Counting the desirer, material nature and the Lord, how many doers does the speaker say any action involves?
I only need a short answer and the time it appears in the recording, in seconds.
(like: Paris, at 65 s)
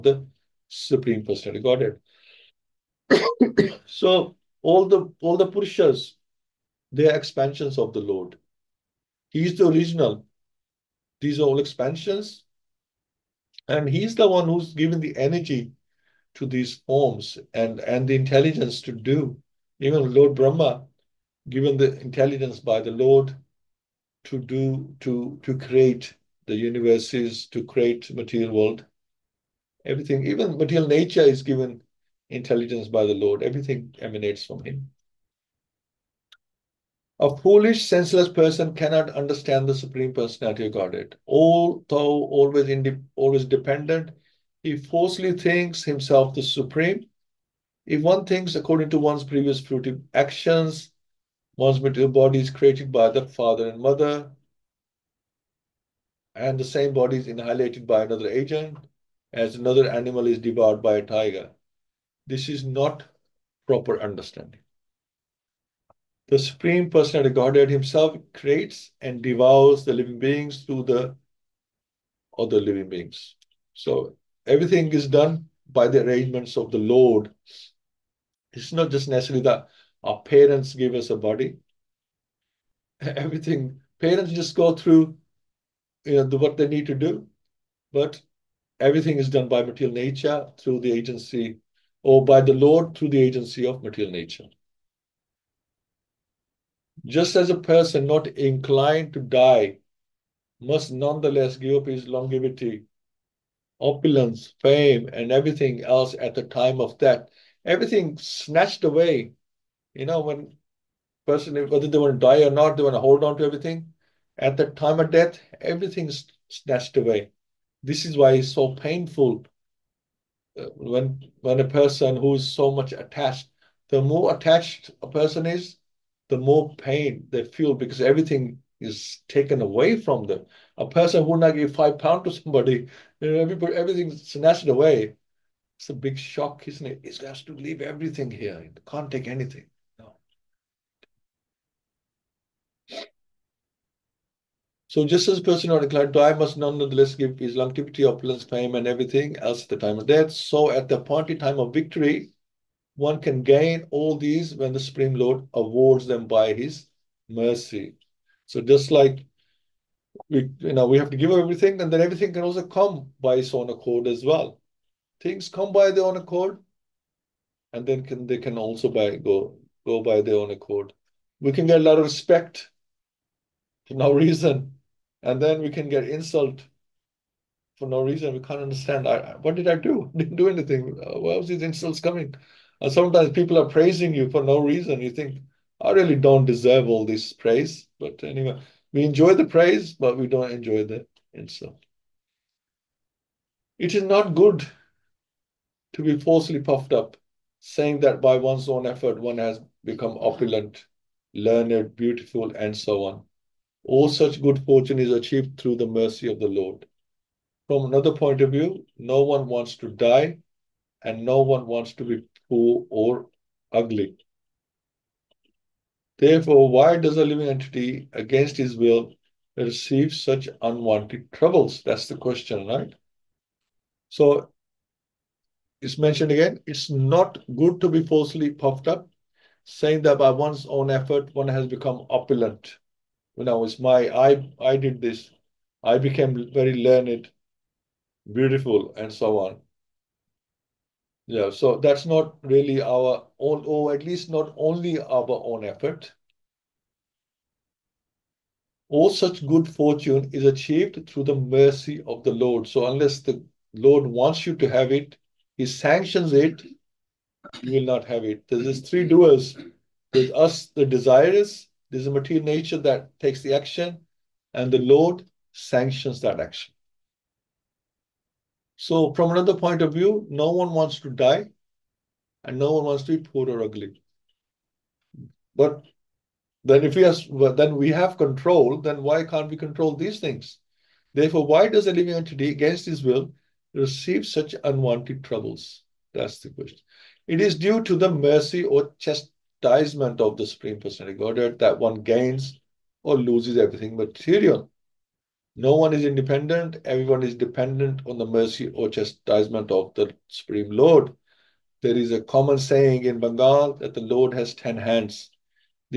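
3, at 258 s.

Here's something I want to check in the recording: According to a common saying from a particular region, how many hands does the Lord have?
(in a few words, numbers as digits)
10.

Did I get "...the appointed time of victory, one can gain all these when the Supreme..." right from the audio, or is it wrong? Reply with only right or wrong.
right.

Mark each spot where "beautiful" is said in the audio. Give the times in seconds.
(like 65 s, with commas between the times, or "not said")
201 s, 238 s.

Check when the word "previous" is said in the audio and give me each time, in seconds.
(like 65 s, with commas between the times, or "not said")
49 s.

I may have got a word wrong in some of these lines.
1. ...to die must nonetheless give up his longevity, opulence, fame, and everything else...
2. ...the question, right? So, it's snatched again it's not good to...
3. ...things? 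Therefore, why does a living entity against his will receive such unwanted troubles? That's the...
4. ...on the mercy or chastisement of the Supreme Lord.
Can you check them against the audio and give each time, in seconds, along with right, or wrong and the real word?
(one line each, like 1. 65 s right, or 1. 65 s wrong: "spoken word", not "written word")
1. 99 s right
2. 222 s wrong: "mentioned", not "snatched"
3. 280 s right
4. 298 s right.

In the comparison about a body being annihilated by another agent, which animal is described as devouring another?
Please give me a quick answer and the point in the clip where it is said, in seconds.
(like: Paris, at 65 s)
tiger, at 61 s.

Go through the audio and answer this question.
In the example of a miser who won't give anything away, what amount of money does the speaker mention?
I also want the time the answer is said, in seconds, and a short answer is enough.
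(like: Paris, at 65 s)
5 pounds, at 131 s.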